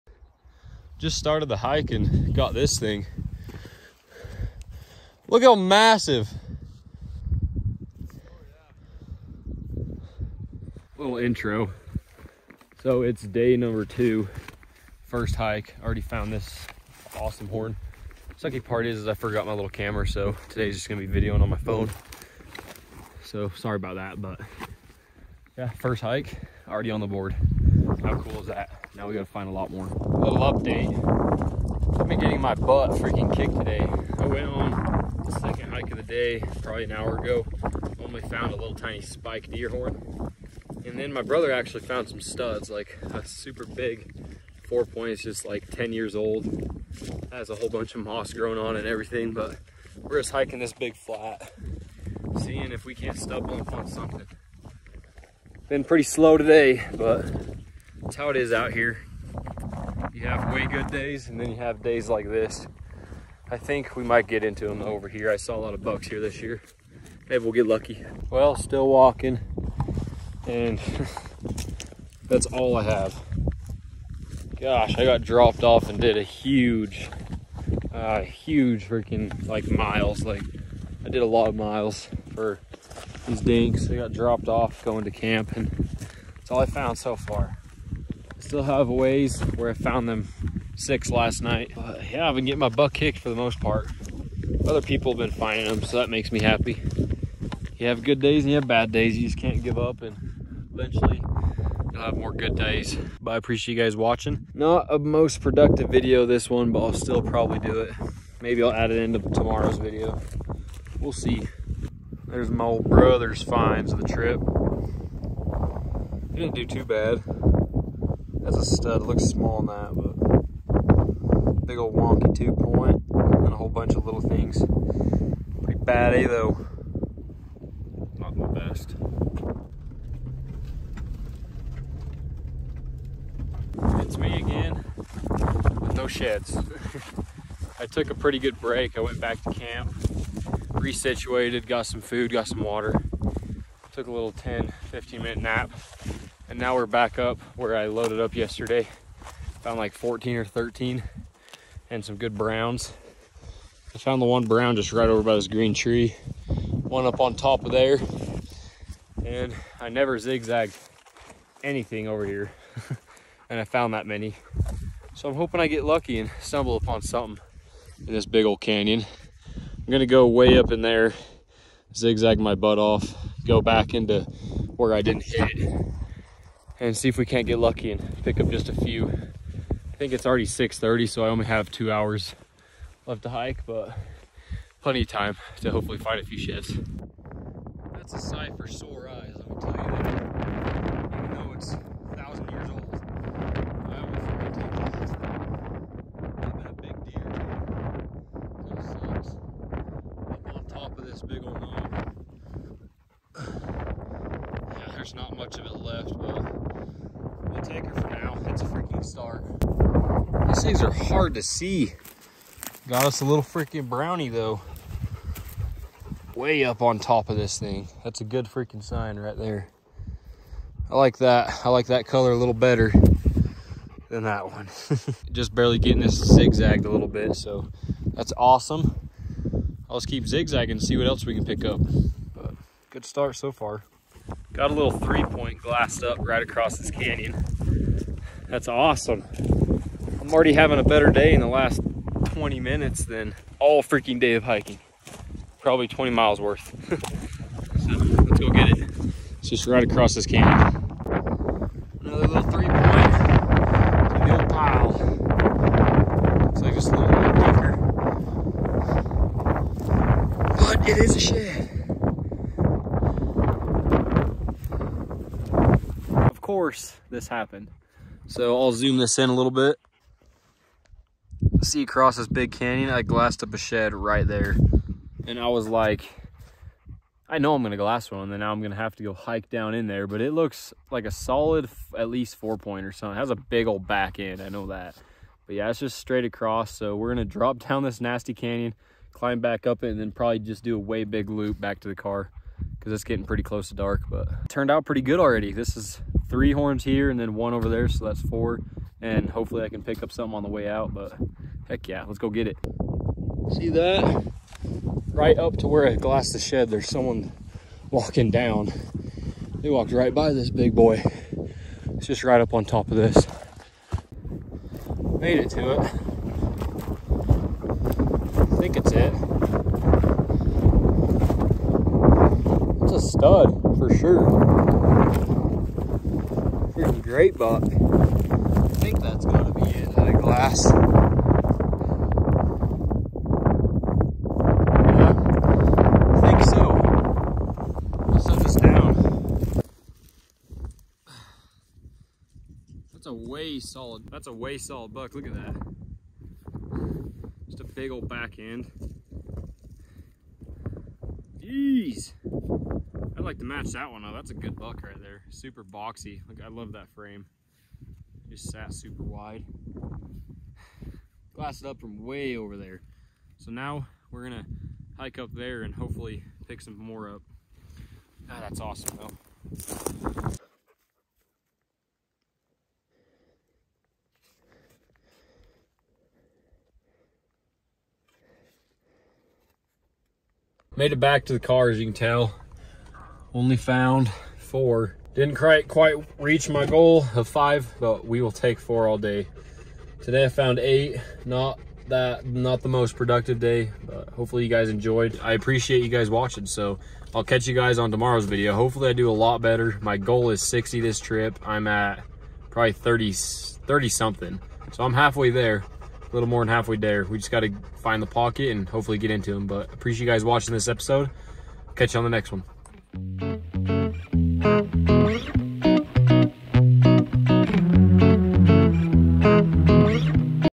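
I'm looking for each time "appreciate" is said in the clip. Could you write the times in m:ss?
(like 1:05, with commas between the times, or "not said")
1:43, 6:35, 6:49.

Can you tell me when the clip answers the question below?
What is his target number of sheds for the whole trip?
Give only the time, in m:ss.
6:40.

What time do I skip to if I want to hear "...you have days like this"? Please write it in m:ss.
1:01.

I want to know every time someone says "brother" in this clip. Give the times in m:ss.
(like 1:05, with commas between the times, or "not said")
0:41, 1:52.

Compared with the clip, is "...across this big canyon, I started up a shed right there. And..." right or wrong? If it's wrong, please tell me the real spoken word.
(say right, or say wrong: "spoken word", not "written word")
wrong: "glassed", not "started".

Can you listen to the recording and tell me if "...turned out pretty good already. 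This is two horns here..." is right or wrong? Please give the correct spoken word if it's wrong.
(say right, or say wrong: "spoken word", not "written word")
wrong: "three", not "two".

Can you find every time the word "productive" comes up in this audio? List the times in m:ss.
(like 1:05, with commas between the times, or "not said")
1:45, 6:32.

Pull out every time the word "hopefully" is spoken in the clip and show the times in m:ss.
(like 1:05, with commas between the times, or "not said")
3:05, 4:59, 6:05, 6:34, 6:38, 6:48.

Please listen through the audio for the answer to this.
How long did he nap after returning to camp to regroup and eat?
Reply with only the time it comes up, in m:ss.
2:24.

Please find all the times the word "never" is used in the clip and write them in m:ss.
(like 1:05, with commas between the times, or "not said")
2:39.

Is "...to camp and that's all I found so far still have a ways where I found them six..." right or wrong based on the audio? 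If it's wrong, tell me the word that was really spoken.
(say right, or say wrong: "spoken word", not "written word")
right.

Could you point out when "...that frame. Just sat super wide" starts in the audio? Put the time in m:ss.
5:56.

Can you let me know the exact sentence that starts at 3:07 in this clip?
That's a sight for sore eyes, I'm gonna tell you that.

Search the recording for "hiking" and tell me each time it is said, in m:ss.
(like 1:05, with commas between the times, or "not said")
0:50, 4:04.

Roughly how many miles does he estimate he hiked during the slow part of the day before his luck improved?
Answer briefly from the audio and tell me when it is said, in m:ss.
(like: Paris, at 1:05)
20 miles, at 4:05.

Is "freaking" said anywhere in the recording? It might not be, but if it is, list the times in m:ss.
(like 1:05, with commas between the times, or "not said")
0:32, 1:18, 3:28, 3:33, 3:38, 4:03, 5:26.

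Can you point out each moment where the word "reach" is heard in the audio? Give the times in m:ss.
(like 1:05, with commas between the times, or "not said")
6:26.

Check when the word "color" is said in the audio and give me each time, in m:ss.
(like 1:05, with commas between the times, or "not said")
3:42.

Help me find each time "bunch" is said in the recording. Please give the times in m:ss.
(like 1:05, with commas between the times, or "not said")
0:47, 2:03.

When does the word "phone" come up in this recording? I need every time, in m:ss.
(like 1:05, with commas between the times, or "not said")
0:21.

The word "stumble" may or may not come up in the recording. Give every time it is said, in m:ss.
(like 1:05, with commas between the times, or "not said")
0:53, 2:46.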